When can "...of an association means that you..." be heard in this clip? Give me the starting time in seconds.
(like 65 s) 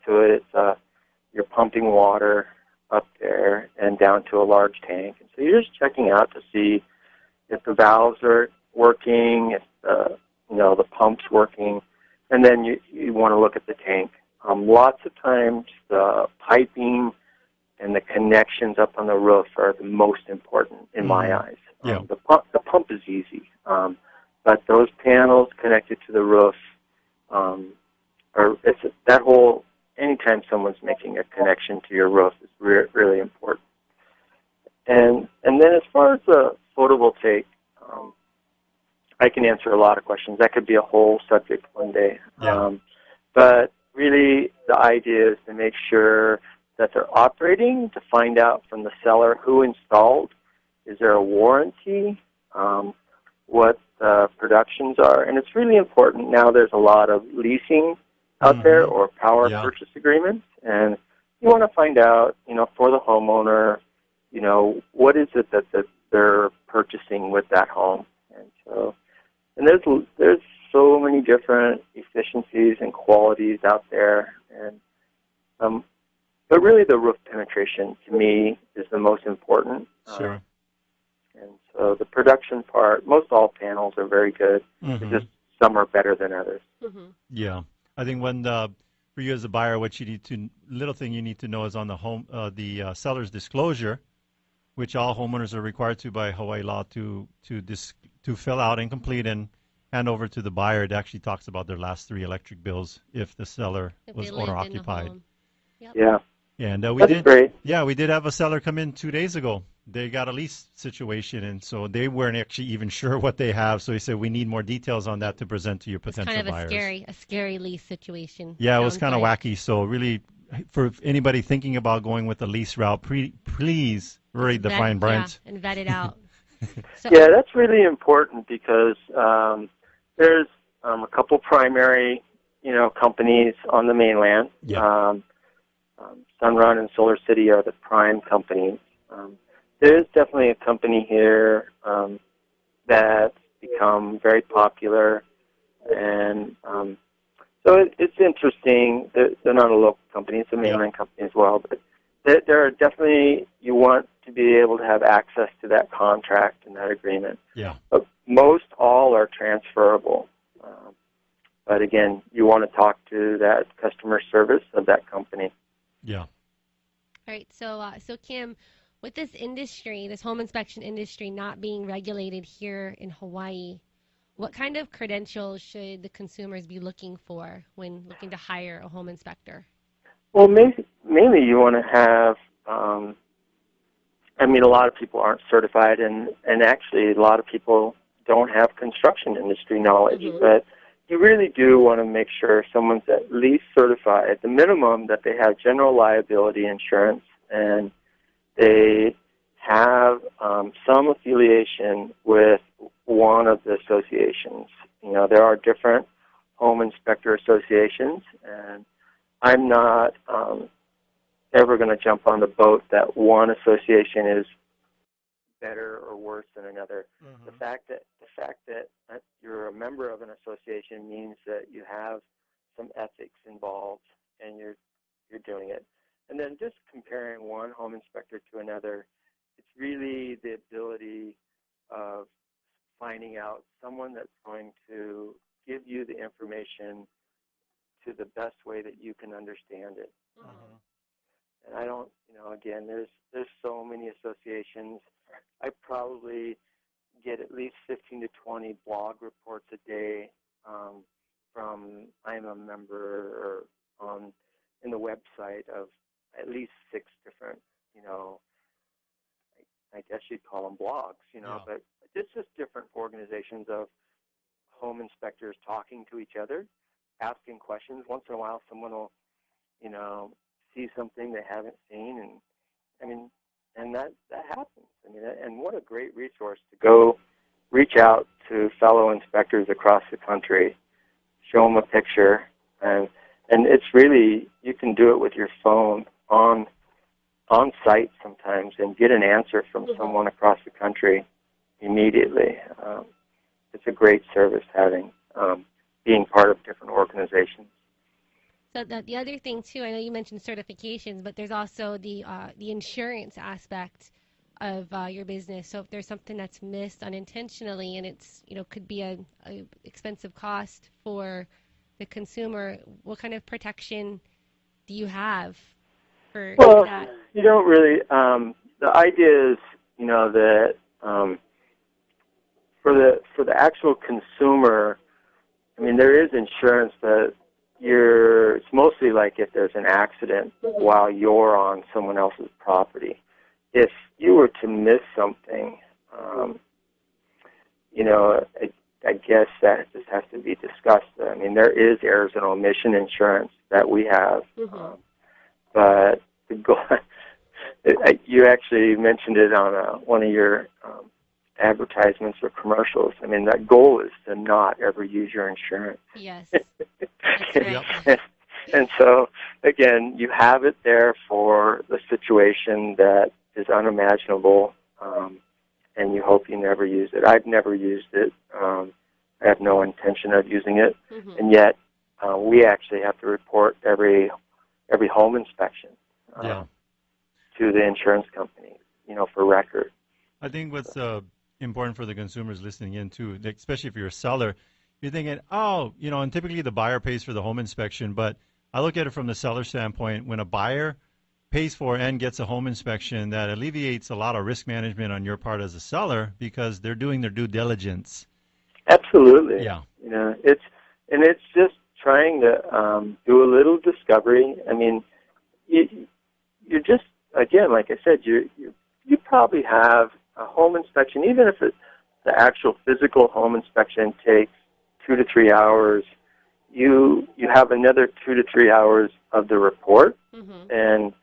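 220 s.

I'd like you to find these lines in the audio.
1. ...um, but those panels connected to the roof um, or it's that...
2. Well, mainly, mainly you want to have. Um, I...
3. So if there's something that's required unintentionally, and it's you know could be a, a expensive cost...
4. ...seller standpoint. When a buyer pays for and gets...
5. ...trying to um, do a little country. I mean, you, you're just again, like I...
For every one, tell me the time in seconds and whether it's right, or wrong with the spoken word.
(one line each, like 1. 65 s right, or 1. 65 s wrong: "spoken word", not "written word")
1. 23 s right
2. 180 s right
3. 305 s wrong: "missed", not "required"
4. 389 s right
5. 402 s wrong: "discovery", not "country".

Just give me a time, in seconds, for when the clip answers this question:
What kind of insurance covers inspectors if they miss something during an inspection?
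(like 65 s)
342 s.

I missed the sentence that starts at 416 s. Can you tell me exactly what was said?
You you have another two to three hours of the report, mm-hmm.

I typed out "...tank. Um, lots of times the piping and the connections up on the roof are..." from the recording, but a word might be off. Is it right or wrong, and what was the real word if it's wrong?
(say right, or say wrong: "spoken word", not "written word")
right.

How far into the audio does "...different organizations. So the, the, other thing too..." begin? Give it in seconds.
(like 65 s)
296 s.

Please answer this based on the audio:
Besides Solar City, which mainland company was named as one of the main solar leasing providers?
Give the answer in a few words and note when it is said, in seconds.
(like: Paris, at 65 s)
Sunrun, at 136 s.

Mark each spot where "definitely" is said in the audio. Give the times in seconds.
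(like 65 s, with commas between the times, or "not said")
140 s, 152 s.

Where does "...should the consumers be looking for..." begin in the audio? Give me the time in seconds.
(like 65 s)
175 s.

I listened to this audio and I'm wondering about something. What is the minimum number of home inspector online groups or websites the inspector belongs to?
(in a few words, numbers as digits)
6.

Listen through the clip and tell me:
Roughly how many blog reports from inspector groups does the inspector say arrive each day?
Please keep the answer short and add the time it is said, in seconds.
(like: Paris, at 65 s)
15 to 20, at 247 s.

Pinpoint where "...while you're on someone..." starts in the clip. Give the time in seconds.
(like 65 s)
330 s.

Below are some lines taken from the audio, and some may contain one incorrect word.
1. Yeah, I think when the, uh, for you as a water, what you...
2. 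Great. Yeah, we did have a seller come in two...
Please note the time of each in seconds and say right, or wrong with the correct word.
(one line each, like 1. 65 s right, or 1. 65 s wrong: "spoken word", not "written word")
1. 87 s wrong: "buyer", not "water"
2. 107 s right.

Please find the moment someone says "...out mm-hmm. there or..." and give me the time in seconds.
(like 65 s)
58 s.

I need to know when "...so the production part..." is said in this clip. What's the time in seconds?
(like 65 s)
81 s.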